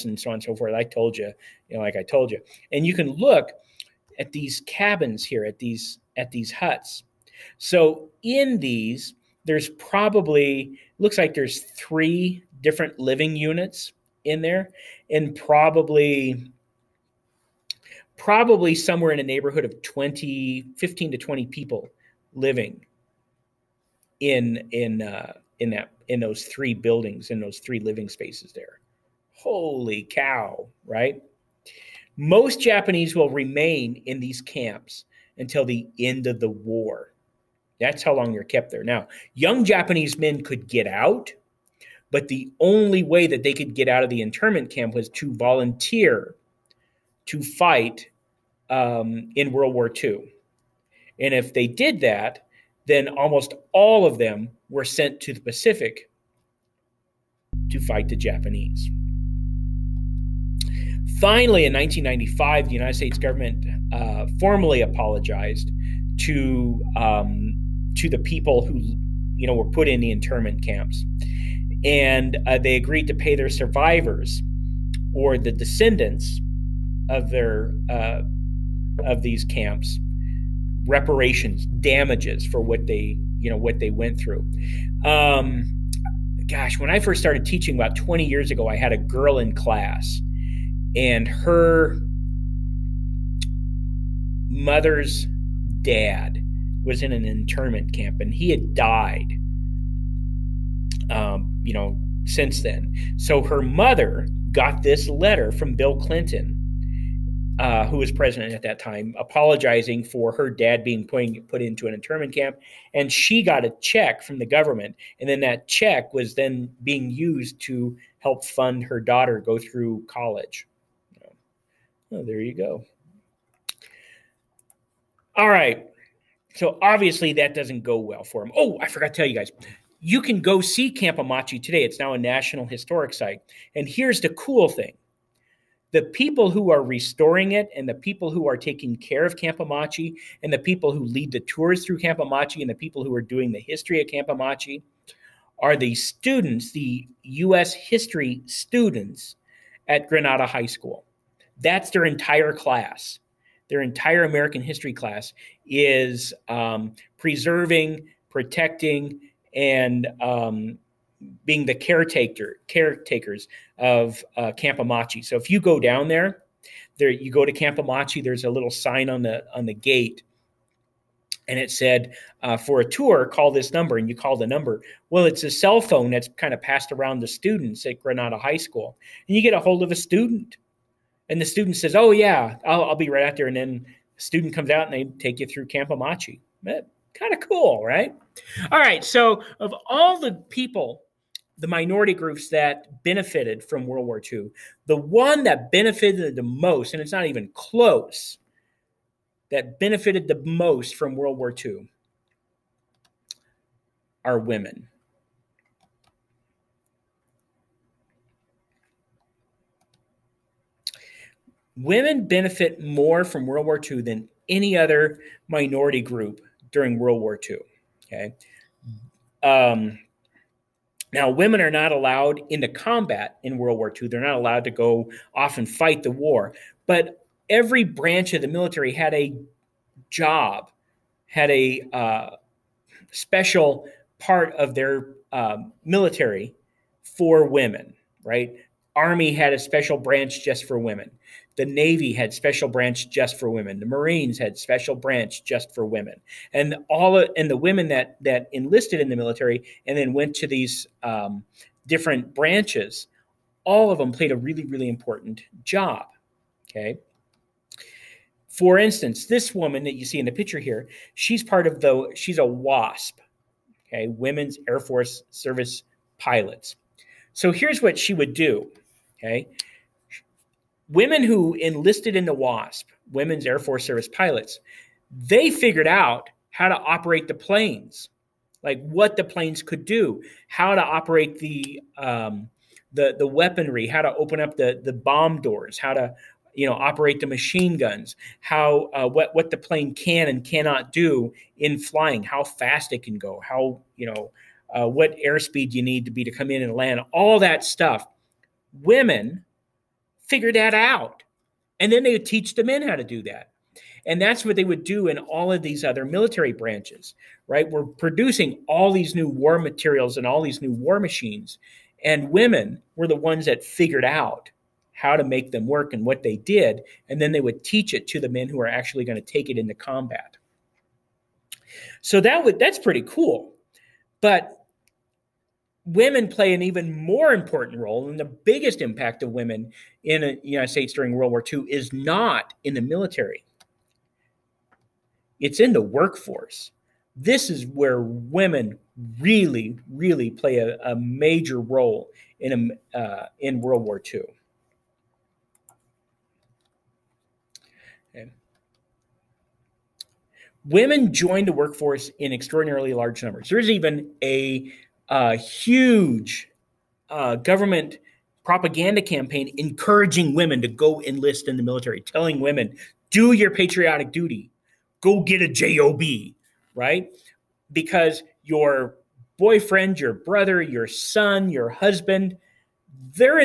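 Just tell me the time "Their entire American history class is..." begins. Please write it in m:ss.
2:33.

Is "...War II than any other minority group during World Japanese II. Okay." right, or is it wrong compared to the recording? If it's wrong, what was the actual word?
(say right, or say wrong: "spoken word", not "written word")
wrong: "War", not "Japanese".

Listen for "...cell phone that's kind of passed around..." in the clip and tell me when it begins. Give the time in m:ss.
2:55.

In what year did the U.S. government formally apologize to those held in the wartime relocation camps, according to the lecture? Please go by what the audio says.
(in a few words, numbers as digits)
1995.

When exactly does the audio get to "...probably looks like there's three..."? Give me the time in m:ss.
0:09.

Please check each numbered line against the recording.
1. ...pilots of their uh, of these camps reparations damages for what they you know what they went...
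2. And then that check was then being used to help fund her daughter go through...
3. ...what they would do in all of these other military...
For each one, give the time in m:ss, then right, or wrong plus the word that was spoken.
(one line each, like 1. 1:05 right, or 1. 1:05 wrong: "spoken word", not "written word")
1. 1:15 wrong: "descendants", not "pilots"
2. 1:55 right
3. 5:04 right.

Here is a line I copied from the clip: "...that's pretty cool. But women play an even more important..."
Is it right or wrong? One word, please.
right.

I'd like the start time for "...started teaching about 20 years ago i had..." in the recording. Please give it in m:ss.
1:27.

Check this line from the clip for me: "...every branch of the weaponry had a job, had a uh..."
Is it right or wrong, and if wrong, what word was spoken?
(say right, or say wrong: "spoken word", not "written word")
wrong: "military", not "weaponry".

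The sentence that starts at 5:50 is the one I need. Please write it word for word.
Women joined the workforce in extraordinarily large numbers.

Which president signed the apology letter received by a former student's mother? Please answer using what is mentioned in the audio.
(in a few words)
Bill Clinton.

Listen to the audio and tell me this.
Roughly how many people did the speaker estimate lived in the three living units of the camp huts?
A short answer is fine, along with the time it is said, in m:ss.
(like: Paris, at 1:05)
15 to 20, at 0:19.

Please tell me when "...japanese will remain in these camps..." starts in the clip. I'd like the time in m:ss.
0:32.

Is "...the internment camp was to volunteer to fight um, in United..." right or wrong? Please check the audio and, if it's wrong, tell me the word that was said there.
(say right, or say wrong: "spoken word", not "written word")
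wrong: "World", not "United".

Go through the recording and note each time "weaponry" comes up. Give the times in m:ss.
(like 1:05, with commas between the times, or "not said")
4:43.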